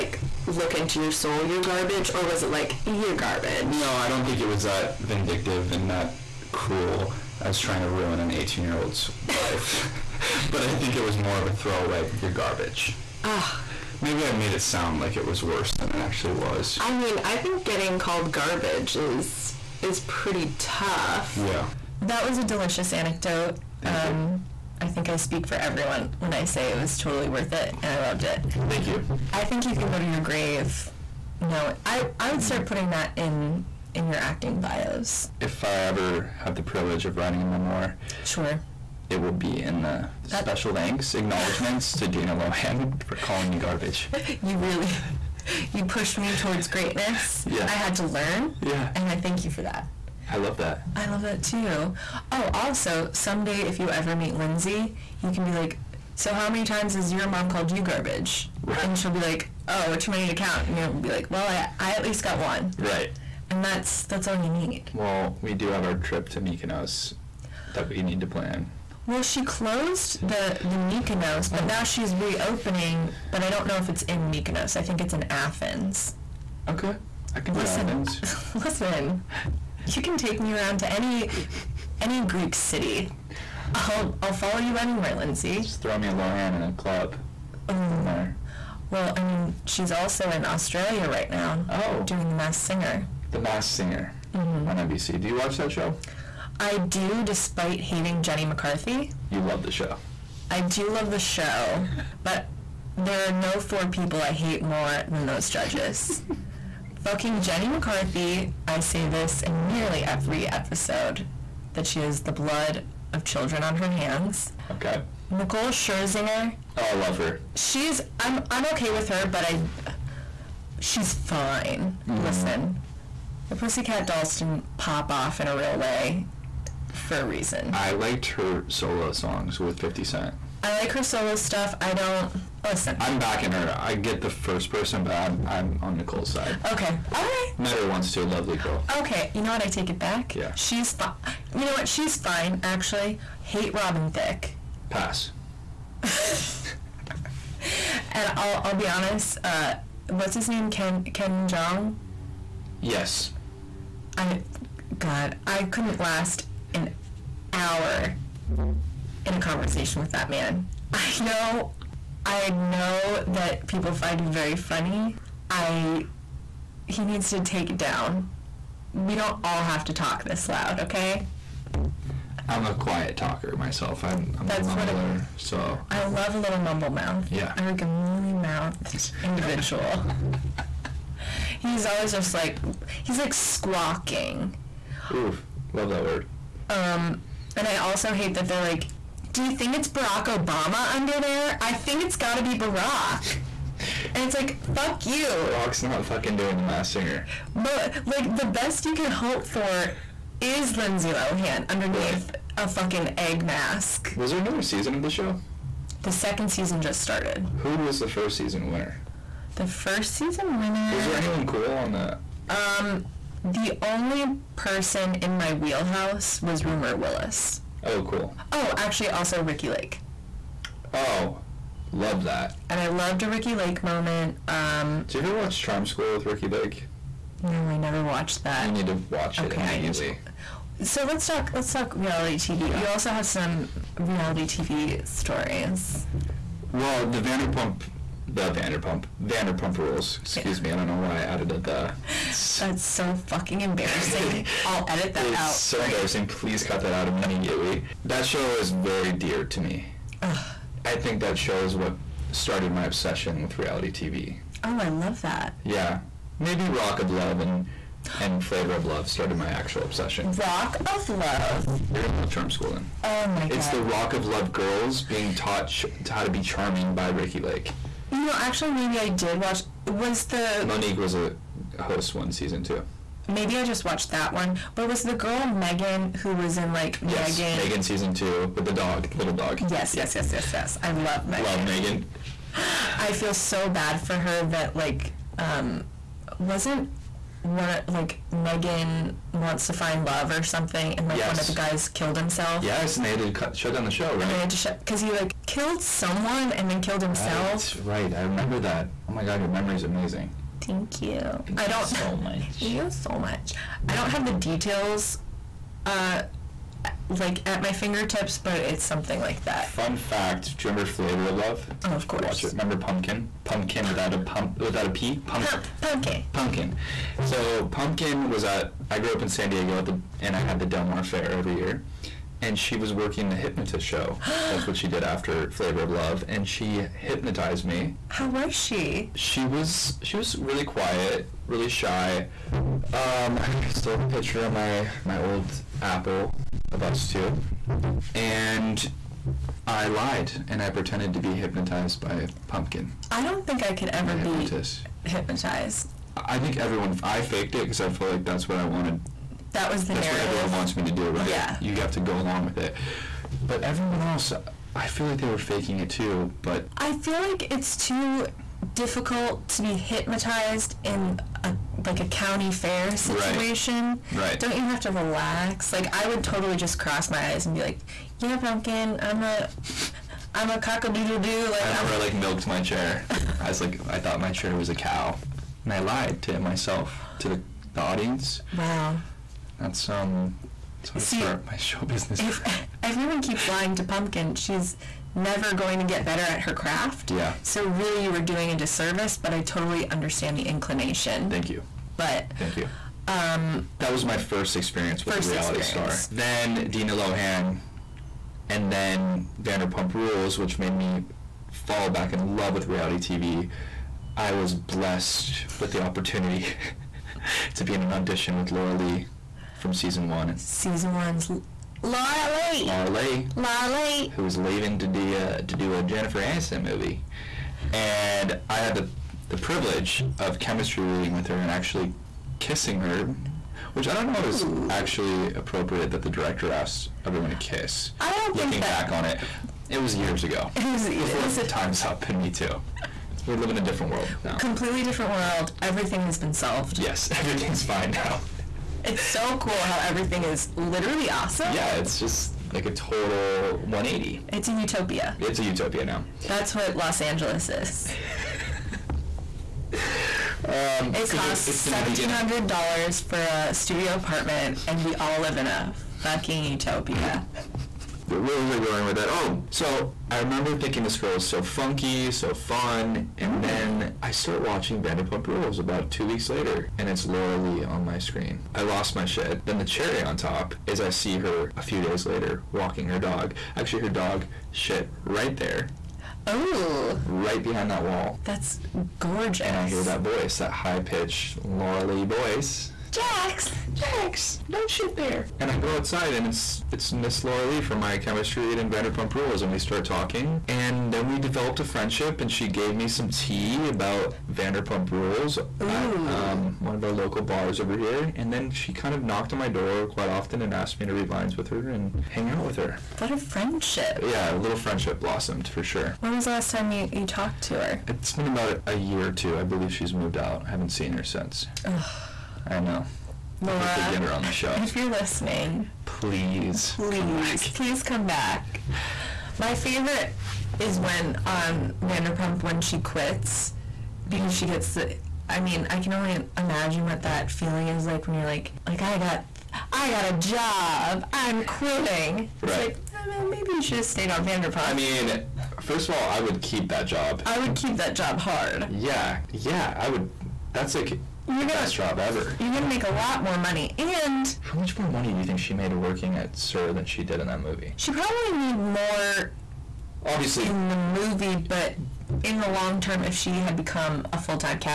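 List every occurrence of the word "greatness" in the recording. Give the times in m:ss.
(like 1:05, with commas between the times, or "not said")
0:46.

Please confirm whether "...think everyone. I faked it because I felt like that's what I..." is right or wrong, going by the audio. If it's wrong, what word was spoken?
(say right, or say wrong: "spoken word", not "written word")
right.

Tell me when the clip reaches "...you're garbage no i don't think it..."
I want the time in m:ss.
0:02.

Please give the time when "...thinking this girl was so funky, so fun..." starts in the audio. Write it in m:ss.
7:40.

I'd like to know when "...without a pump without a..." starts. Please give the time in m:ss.
5:13.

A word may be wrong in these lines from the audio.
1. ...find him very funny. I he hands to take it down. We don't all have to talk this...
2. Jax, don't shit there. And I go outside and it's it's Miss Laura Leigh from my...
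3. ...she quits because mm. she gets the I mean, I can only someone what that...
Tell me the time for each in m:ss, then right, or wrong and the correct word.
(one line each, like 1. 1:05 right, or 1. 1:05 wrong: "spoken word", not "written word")
1. 2:43 wrong: "needs", not "hands"
2. 8:03 right
3. 8:42 wrong: "imagine", not "someone".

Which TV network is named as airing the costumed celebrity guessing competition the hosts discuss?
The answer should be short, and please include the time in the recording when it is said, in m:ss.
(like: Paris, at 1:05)
NBC, at 1:34.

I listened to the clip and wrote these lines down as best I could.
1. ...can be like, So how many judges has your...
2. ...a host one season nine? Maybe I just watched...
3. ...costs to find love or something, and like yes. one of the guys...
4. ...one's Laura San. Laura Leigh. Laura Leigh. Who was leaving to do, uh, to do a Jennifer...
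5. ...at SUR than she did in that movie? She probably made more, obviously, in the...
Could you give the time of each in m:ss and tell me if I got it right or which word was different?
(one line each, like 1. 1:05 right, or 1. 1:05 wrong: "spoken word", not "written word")
1. 0:55 wrong: "times", not "judges"
2. 4:31 wrong: "two", not "nine"
3. 4:49 wrong: "wants", not "costs"
4. 6:50 wrong: "Leigh", not "San"
5. 9:06 right.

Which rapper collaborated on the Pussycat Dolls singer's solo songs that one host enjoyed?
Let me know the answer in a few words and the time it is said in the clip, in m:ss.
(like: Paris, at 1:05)
50 Cent, at 2:09.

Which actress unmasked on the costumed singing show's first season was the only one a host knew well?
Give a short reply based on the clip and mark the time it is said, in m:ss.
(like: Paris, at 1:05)
Rumer Willis, at 3:36.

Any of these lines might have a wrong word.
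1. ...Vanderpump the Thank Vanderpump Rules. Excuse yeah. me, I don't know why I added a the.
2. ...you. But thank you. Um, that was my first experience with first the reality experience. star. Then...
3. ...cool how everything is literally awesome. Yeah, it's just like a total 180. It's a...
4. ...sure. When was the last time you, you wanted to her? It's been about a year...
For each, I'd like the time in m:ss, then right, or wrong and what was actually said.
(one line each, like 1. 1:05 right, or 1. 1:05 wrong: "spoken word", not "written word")
1. 3:57 wrong: "Vanderpump", not "Thank"
2. 6:31 right
3. 7:19 right
4. 8:25 wrong: "talked", not "wanted".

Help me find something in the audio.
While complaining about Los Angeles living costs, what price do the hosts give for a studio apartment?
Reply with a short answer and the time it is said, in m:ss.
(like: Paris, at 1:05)
$1,700, at 7:31.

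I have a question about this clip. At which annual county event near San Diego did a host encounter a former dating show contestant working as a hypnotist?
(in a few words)
Del Mar Fair.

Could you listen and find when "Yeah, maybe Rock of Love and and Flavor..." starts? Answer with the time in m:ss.
4:15.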